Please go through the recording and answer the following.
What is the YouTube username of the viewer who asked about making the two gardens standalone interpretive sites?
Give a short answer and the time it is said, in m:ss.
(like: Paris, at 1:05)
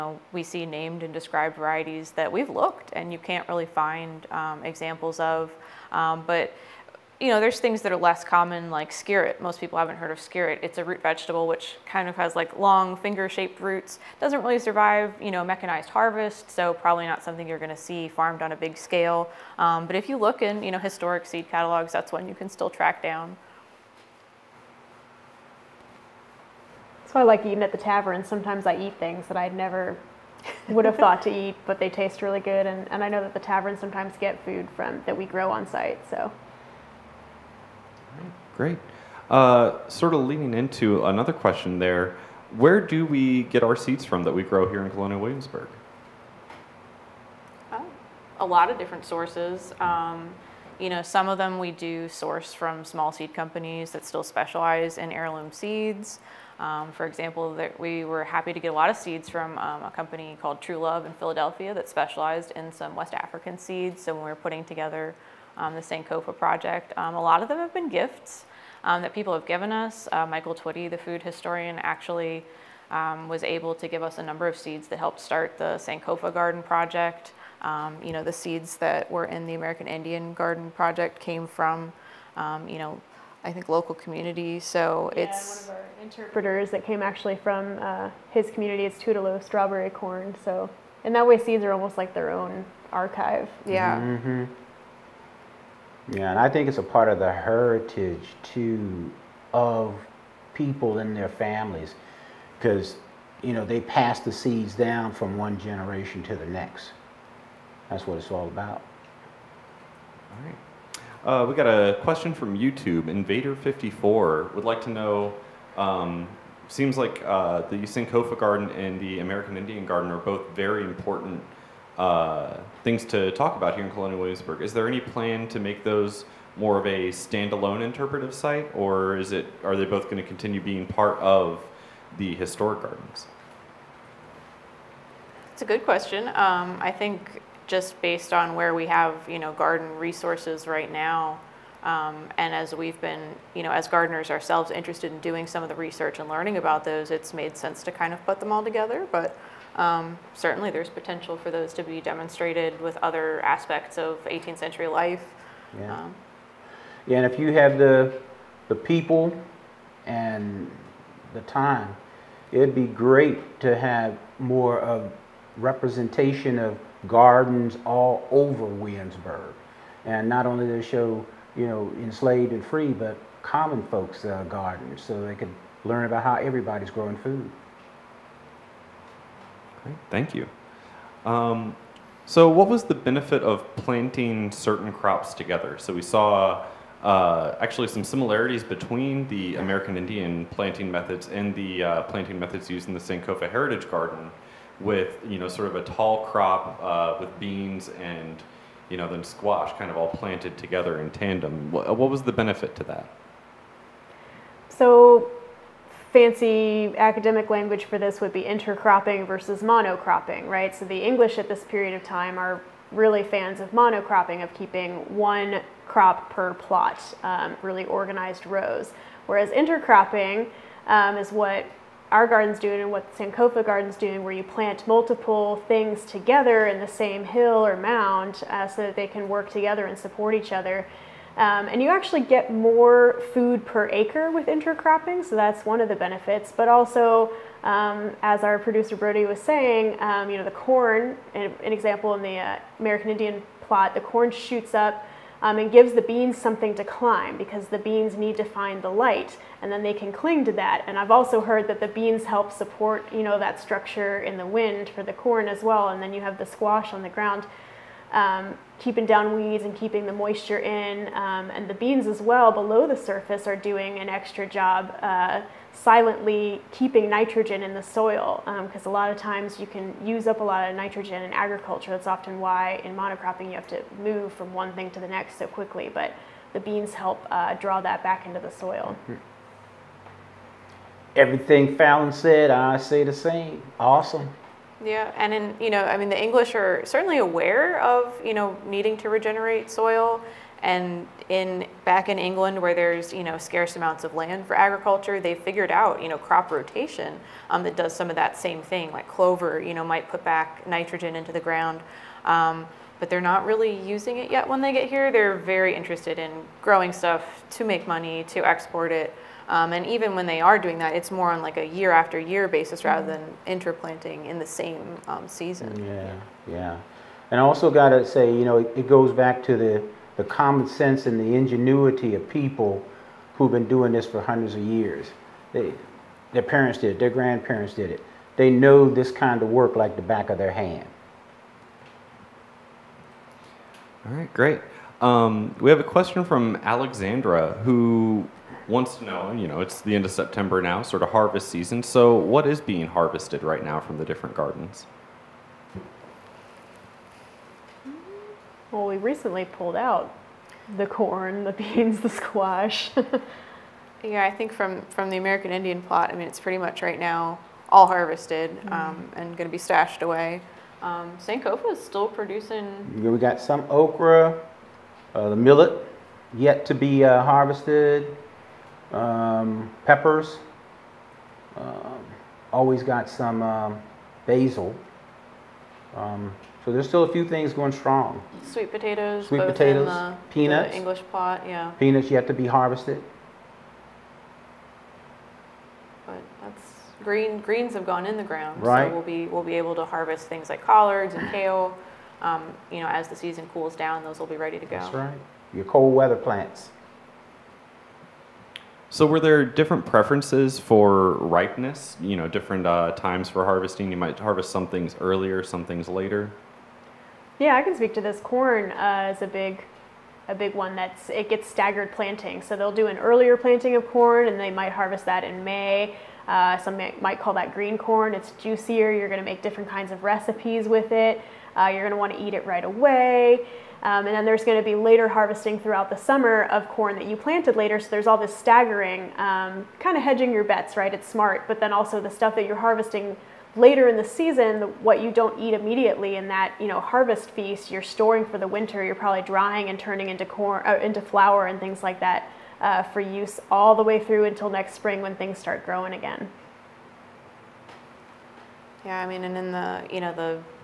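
Invader54, at 1:53.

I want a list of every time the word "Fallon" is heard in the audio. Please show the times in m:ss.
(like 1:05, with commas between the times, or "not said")
4:41.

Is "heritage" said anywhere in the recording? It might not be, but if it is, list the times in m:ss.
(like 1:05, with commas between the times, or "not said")
1:37, 3:13.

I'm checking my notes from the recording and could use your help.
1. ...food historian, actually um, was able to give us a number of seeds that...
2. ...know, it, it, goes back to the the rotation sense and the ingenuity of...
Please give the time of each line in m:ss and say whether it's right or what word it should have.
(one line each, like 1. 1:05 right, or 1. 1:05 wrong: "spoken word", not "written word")
1. 1:10 right
2. 5:18 wrong: "common", not "rotation".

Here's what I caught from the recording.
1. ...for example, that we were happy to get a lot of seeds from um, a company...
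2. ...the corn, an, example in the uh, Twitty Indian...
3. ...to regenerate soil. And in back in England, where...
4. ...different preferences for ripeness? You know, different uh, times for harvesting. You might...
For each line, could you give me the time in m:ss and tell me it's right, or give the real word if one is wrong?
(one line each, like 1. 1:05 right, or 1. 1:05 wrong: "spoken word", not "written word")
1. 0:56 right
2. 4:00 wrong: "American", not "Twitty"
3. 4:48 right
4. 6:39 right.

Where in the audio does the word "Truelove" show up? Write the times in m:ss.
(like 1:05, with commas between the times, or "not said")
1:00.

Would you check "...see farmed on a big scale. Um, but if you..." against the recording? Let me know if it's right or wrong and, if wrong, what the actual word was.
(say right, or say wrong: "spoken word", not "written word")
right.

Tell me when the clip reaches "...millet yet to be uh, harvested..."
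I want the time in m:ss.
6:05.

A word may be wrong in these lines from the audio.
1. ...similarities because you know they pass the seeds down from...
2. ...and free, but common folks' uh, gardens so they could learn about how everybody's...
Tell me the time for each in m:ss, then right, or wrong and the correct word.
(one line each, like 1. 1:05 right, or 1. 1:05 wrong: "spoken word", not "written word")
1. 1:41 wrong: "families", not "similarities"
2. 2:52 right.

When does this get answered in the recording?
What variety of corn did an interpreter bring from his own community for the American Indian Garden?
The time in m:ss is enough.
1:28.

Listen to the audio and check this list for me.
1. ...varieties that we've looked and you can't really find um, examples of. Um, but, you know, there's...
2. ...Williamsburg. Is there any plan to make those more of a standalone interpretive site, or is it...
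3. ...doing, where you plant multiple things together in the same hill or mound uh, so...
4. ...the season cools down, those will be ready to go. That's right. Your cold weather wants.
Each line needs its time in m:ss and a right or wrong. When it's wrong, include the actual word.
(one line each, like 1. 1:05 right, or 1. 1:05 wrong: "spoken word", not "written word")
1. 0:01 right
2. 2:04 right
3. 3:43 right
4. 6:33 wrong: "plants", not "wants".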